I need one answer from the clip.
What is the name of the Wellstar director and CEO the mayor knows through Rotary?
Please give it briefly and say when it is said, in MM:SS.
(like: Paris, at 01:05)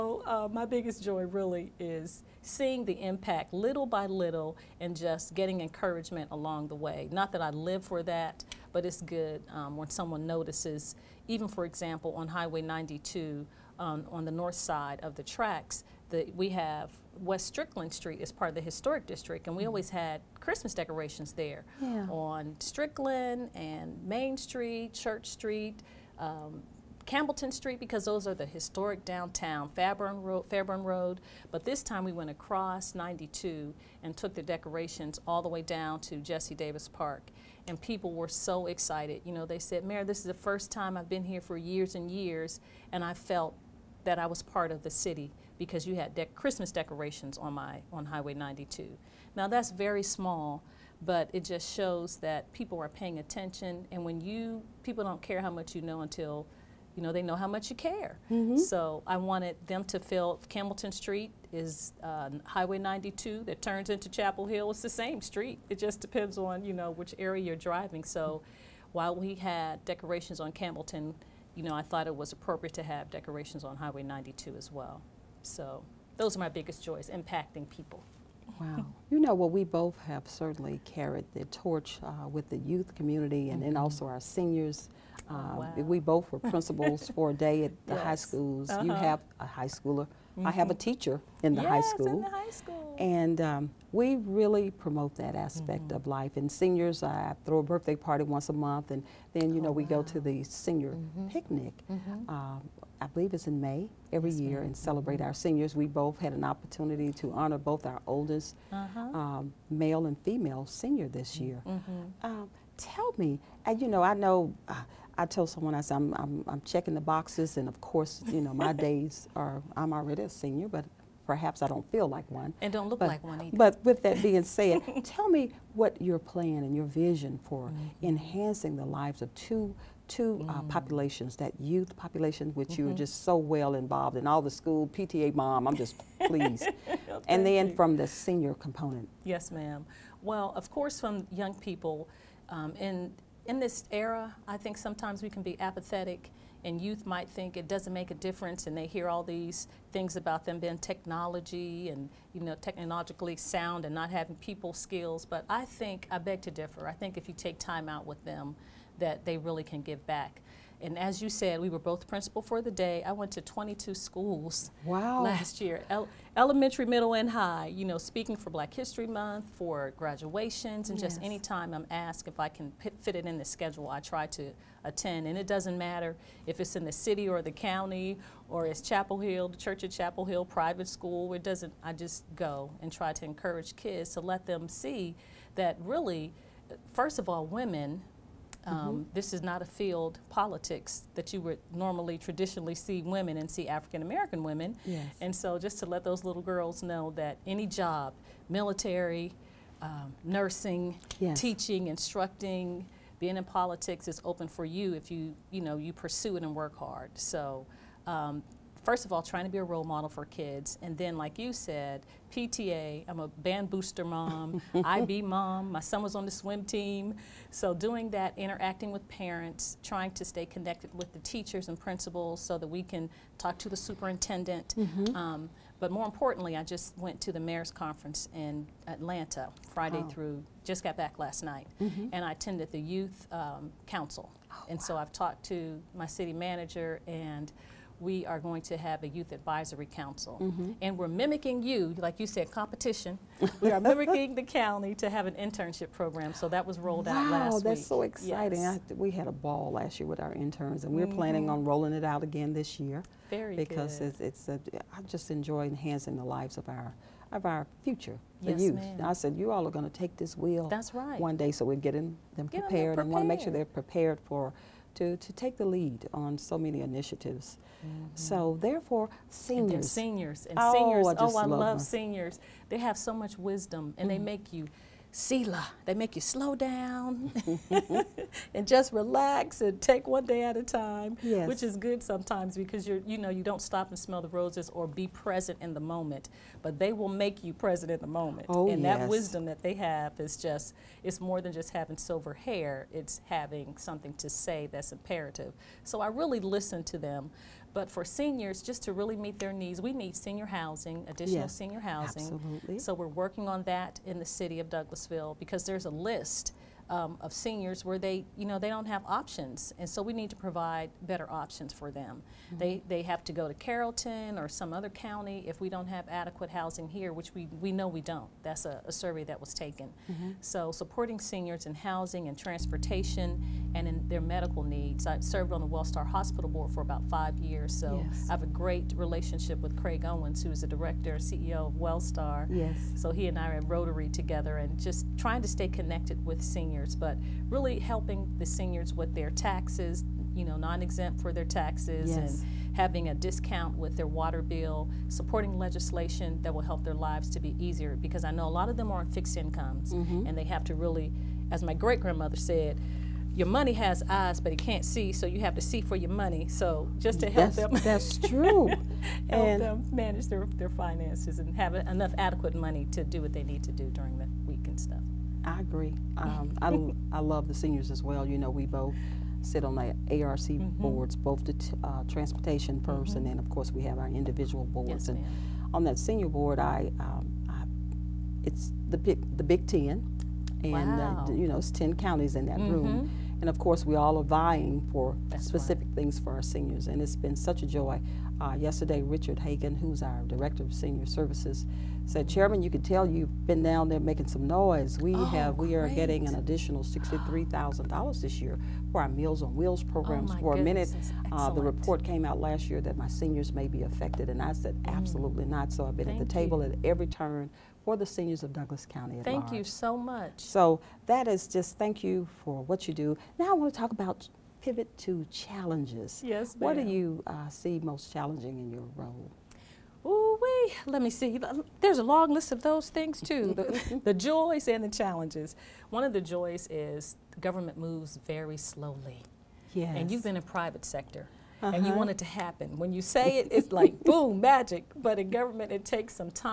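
Craig Owens, at 05:29.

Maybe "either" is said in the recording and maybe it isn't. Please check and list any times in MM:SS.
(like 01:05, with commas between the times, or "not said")
02:03.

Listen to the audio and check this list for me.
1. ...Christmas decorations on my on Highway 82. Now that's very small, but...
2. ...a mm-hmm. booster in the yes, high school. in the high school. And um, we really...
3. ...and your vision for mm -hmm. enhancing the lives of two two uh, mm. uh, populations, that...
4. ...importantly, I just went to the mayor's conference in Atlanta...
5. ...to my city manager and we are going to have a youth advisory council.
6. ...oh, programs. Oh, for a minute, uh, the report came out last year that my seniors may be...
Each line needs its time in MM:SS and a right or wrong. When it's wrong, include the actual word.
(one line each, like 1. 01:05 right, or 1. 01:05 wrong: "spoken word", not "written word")
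1. 00:46 wrong: "92", not "82"
2. 01:30 wrong: "teacher", not "booster"
3. 02:06 right
4. 03:46 right
5. 03:55 right
6. 06:39 right.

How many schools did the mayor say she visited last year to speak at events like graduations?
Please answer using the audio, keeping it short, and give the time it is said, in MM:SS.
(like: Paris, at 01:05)
22, at 02:43.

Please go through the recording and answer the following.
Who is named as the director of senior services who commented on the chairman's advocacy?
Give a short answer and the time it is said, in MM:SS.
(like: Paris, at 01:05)
Richard Hagan, at 06:29.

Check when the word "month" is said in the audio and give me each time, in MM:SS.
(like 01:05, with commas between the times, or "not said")
01:38, 02:49.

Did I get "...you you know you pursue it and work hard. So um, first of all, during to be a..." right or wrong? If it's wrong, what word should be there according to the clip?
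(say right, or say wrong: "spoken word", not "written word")
wrong: "trying", not "during".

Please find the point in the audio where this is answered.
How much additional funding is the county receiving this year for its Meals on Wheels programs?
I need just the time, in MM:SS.
06:36.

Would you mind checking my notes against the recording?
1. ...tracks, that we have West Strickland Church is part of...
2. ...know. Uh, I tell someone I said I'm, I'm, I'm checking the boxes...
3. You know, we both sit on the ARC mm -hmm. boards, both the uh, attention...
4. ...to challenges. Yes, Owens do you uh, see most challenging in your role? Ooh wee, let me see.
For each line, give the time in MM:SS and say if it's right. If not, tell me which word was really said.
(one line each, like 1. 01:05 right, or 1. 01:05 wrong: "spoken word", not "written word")
1. 00:15 wrong: "Street", not "Church"
2. 01:54 right
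3. 06:08 wrong: "transportation", not "attention"
4. 06:54 wrong: "What", not "Owens".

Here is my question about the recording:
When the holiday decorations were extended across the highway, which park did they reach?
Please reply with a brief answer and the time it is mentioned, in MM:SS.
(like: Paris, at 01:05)
Jesse Davis Park, at 00:36.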